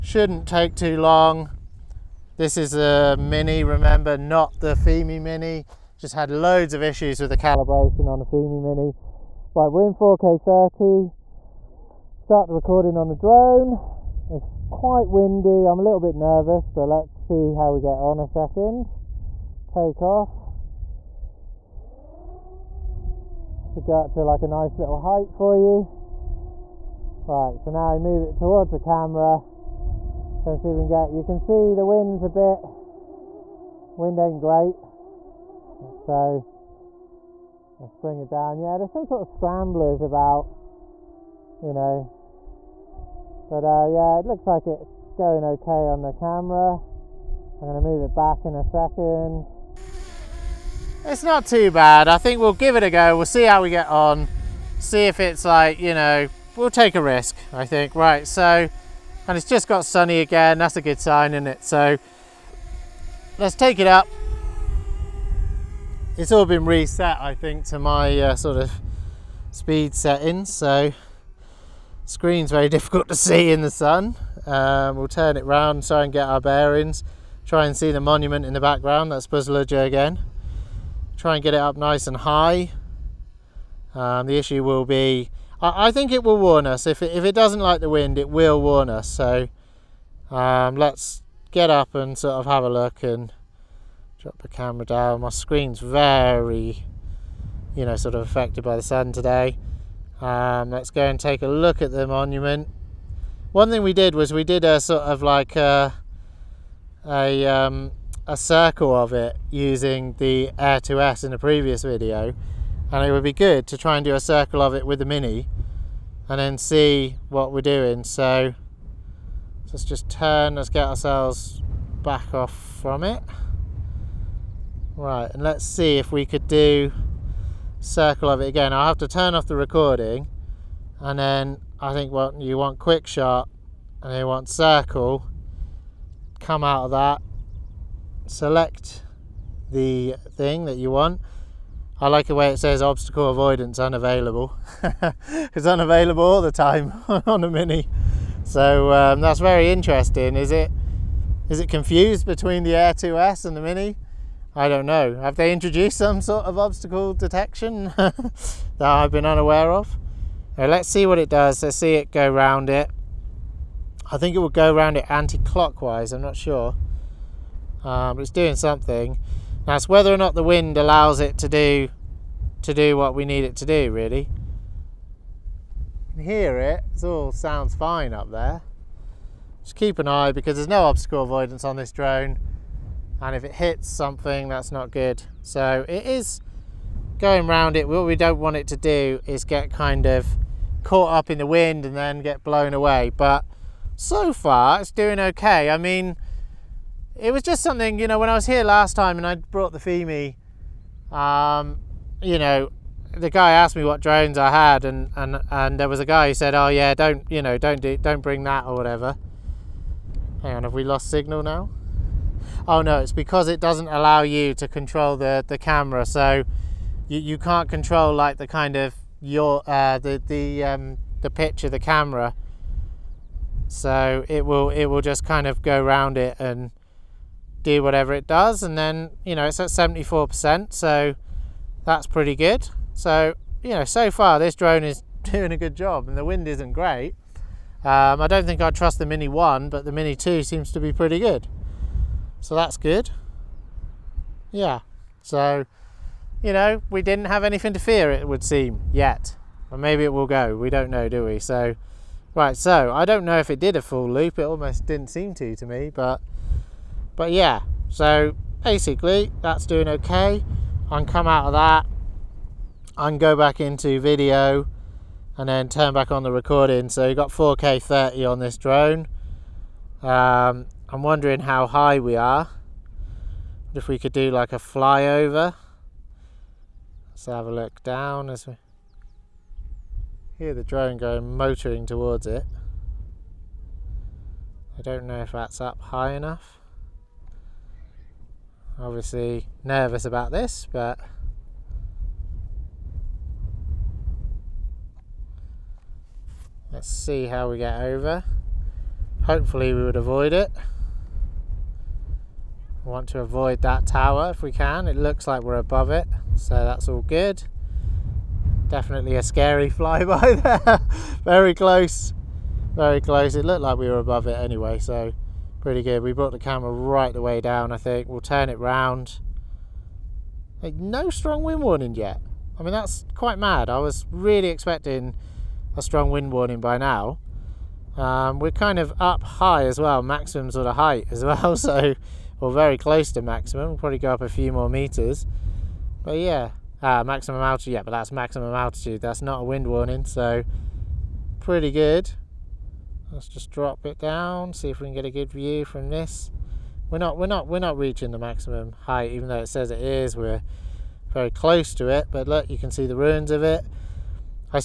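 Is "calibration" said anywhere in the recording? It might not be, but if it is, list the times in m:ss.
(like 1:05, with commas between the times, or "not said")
0:07.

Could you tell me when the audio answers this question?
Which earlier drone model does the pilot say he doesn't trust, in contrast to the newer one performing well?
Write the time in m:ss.
3:59.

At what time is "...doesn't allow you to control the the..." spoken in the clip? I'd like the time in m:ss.
3:33.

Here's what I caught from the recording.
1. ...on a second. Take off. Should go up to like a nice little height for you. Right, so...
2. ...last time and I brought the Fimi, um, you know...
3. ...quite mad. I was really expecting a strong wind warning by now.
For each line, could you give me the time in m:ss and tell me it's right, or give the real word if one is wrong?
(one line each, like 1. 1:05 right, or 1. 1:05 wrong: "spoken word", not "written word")
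1. 0:17 right
2. 3:18 right
3. 5:23 right.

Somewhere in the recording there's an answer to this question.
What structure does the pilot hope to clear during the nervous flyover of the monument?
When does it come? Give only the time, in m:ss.
5:03.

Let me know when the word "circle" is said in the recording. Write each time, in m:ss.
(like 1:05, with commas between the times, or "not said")
1:48, 1:54, 2:07, 2:14.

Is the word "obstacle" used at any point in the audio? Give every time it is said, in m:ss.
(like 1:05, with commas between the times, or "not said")
2:22, 2:36, 3:00.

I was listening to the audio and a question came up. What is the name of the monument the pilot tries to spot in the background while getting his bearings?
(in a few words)
Buzludzha.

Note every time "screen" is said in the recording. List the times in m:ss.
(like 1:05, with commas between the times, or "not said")
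1:12, 1:35.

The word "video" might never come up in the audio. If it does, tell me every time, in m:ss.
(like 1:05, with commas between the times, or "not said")
1:51, 4:23.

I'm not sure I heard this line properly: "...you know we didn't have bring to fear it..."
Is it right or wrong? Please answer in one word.
wrong.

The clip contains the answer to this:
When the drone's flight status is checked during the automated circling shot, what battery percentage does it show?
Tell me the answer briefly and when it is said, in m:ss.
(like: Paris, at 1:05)
74%, at 3:49.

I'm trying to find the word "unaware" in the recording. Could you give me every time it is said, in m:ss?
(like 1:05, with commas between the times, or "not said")
2:39.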